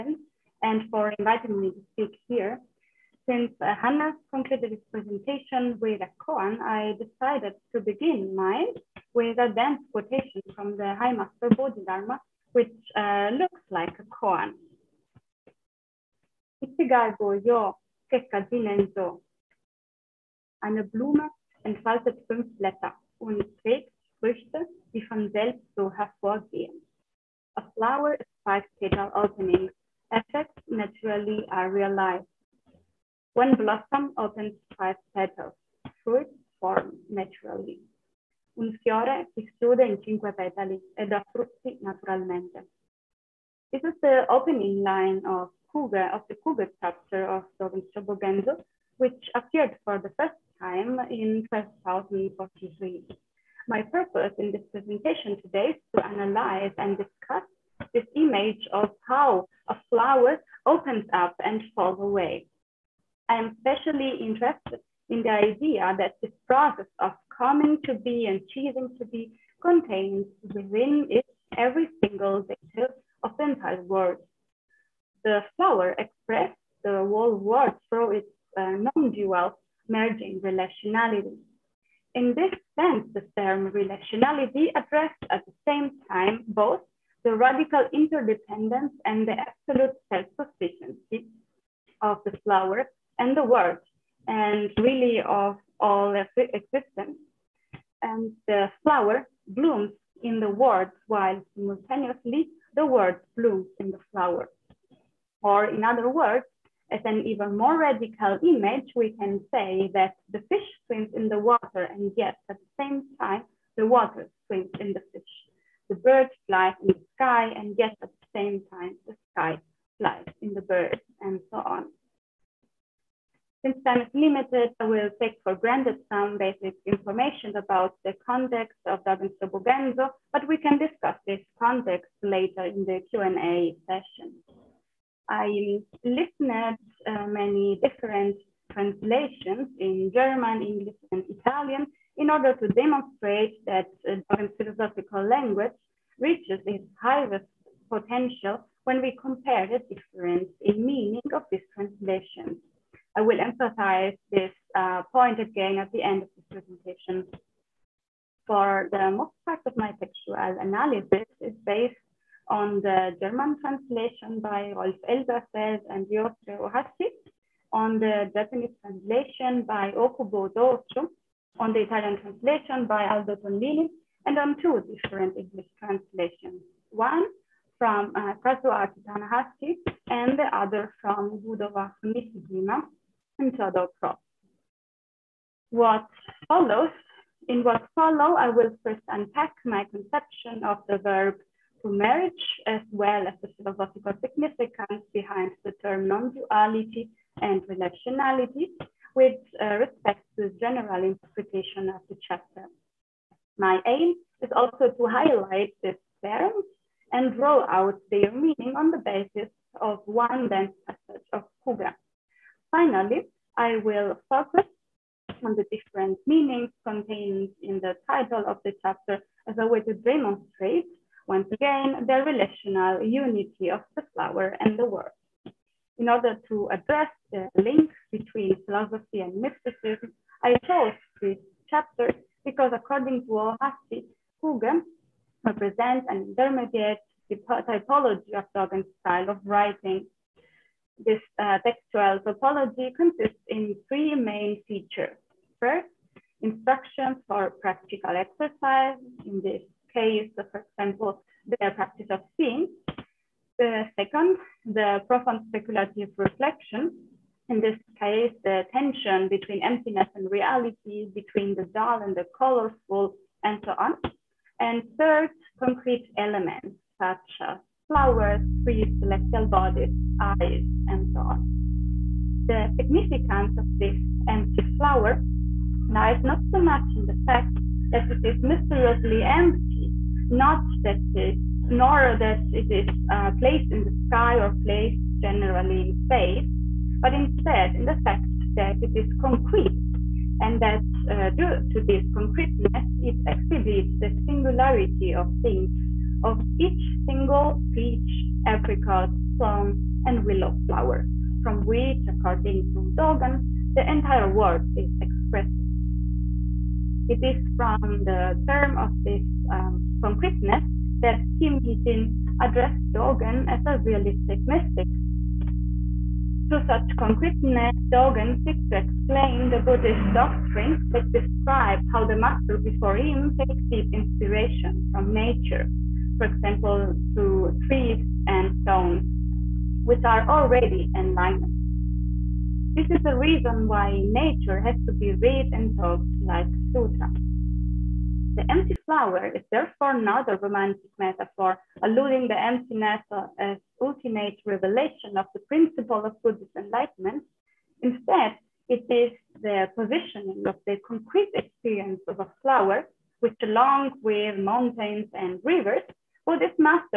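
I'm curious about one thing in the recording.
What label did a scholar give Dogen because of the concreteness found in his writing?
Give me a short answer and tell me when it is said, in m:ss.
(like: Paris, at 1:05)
realistic mystic, at 5:13.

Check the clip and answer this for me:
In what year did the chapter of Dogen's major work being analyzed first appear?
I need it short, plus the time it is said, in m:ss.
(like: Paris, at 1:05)
1243, at 0:51.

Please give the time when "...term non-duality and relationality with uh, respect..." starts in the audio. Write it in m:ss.
3:15.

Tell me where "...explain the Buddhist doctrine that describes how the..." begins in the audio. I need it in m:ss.
5:18.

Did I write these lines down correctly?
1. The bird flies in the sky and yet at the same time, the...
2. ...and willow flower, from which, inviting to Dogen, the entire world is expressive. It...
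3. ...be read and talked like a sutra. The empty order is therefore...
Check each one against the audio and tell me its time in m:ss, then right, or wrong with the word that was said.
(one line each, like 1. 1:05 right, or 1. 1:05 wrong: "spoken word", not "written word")
1. 1:55 right
2. 5:00 wrong: "according", not "inviting"
3. 5:34 wrong: "flower", not "order".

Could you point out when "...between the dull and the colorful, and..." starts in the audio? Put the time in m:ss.
4:21.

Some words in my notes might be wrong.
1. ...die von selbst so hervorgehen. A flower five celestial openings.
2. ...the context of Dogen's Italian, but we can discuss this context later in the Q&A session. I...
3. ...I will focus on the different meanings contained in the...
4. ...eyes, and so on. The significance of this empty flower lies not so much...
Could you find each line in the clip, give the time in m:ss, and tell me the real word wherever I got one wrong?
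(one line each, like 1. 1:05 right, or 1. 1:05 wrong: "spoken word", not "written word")
1. 0:24 wrong: "petal", not "celestial"
2. 2:08 wrong: "Shobogenzo", not "Italian"
3. 3:33 right
4. 4:30 right.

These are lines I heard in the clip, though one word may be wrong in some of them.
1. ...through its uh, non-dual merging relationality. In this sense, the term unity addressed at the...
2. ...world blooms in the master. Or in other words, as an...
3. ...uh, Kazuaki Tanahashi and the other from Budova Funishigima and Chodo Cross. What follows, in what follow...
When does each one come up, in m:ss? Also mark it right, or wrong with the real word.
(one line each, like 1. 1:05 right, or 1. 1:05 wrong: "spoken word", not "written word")
1. 1:17 wrong: "relationality", not "unity"
2. 1:42 wrong: "flower", not "master"
3. 2:58 right.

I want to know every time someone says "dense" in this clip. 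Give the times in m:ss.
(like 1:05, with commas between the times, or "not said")
0:09, 3:30.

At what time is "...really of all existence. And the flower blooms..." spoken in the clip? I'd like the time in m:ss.
1:34.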